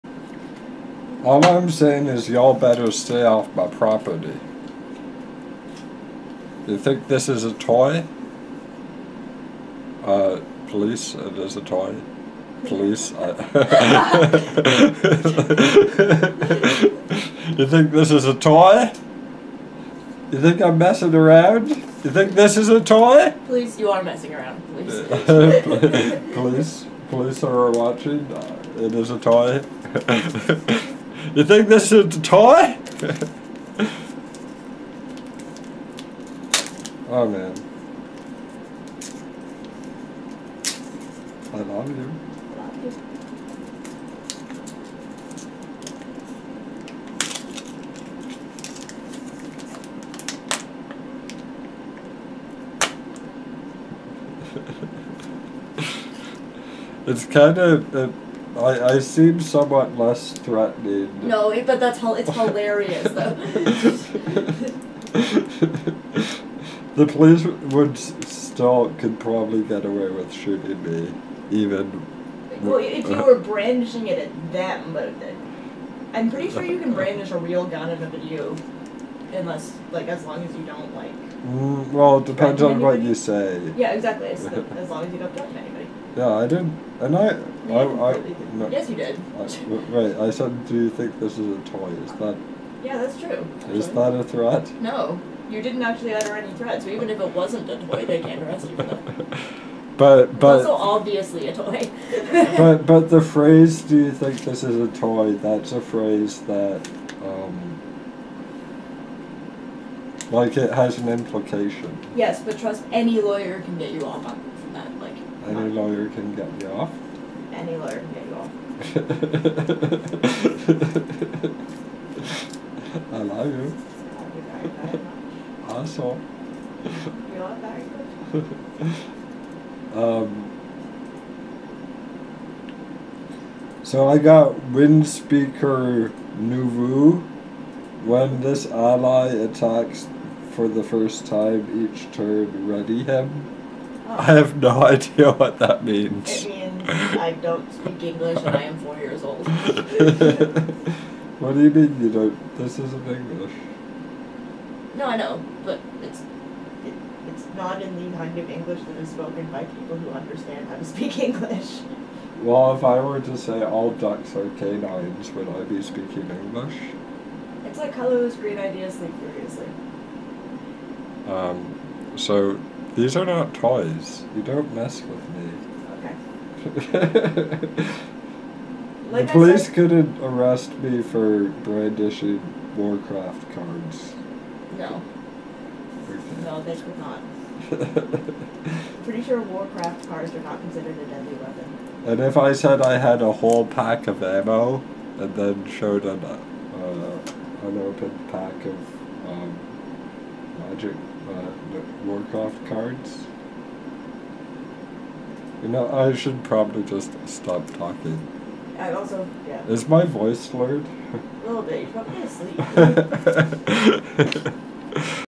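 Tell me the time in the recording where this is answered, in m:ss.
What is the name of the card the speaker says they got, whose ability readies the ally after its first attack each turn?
2:14.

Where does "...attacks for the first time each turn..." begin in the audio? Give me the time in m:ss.
2:19.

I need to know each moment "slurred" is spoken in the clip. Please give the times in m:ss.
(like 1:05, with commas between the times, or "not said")
3:30.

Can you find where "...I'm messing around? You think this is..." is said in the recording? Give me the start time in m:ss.
0:20.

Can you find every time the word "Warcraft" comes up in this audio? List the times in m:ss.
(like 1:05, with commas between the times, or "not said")
3:02, 3:09, 3:22.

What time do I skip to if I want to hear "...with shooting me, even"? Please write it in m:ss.
1:10.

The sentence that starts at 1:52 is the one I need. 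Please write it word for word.
Yes, but trust any lawyer can get you off on, that.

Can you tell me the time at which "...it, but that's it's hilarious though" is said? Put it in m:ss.
1:01.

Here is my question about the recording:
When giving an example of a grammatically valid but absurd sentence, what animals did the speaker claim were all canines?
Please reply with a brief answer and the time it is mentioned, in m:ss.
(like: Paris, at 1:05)
ducks, at 2:43.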